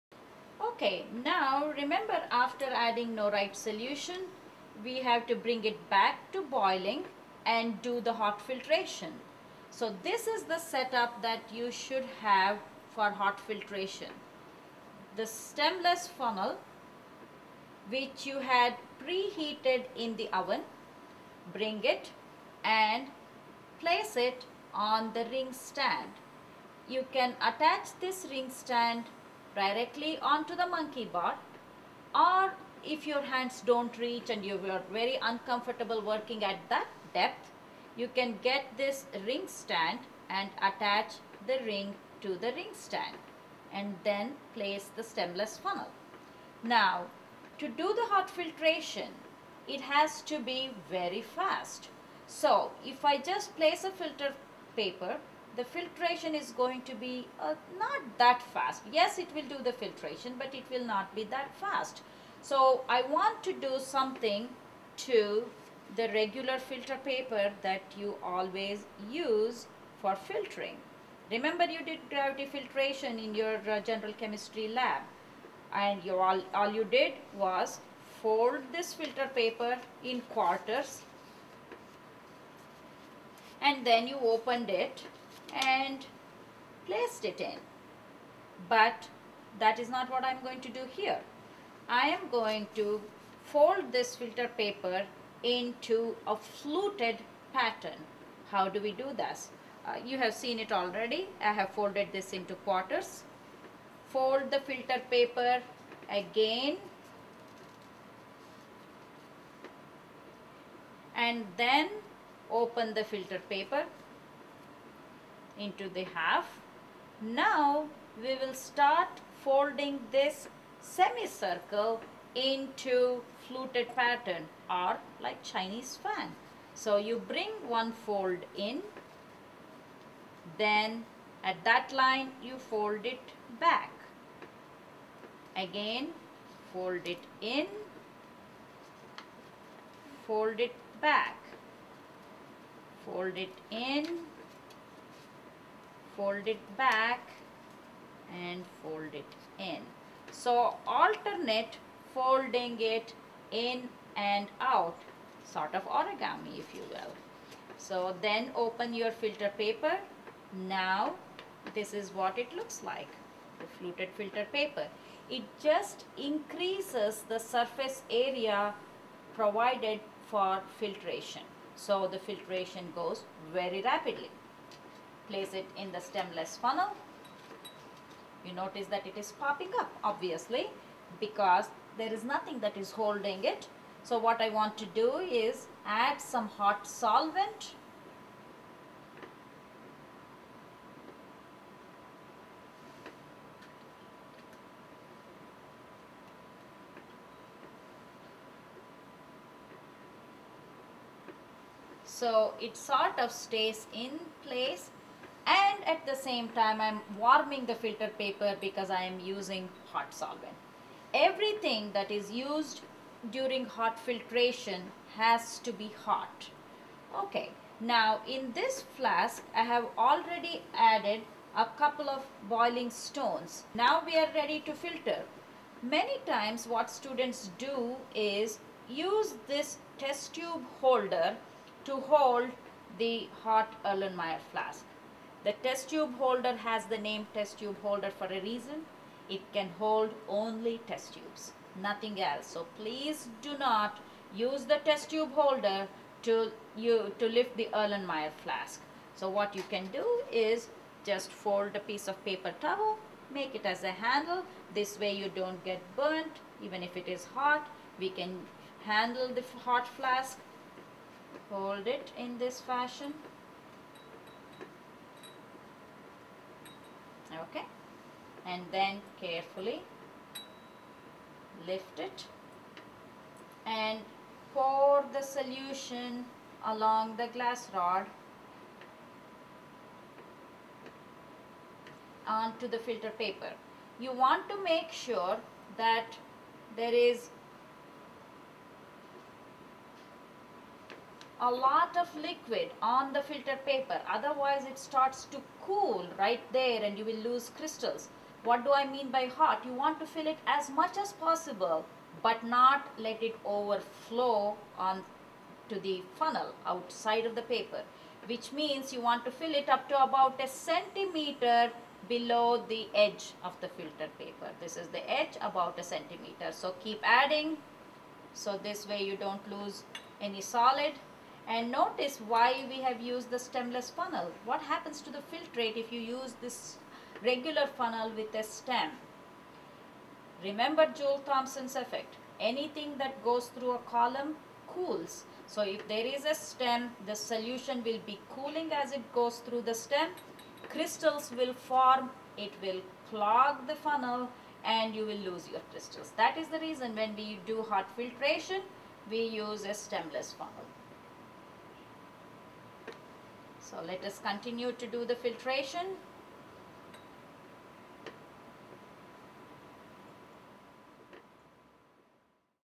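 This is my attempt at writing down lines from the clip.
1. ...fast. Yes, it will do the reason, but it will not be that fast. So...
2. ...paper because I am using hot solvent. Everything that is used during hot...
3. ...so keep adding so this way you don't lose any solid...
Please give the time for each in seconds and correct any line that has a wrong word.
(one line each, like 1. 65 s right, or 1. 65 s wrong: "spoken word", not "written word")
1. 58 s wrong: "filtration", not "reason"
2. 208 s right
3. 316 s right.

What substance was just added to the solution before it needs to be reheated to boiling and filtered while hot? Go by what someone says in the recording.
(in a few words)
Norite.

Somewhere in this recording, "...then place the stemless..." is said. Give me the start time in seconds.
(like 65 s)
44 s.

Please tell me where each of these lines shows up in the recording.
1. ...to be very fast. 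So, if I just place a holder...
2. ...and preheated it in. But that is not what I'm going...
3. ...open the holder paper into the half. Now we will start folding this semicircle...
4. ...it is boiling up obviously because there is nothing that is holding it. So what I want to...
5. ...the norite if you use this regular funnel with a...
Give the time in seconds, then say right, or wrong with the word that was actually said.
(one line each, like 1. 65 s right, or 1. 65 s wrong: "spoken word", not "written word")
1. 50 s wrong: "filter", not "holder"
2. 85 s wrong: "placed", not "preheated"
3. 112 s wrong: "filter", not "holder"
4. 179 s wrong: "popping", not "boiling"
5. 325 s wrong: "filtrate", not "norite".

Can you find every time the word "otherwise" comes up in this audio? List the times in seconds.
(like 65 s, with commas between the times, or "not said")
294 s.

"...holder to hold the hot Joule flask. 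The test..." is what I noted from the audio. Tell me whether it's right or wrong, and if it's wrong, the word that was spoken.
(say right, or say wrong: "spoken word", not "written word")
wrong: "Erlenmeyer", not "Joule".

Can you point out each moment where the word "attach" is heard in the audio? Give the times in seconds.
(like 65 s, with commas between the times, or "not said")
27 s, 40 s.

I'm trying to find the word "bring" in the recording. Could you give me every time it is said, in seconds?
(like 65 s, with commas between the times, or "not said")
5 s, 21 s, 127 s.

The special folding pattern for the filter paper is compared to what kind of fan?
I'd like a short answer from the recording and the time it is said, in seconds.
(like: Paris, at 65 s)
Chinese fan, at 125 s.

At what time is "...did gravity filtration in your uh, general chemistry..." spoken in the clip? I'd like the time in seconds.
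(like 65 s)
71 s.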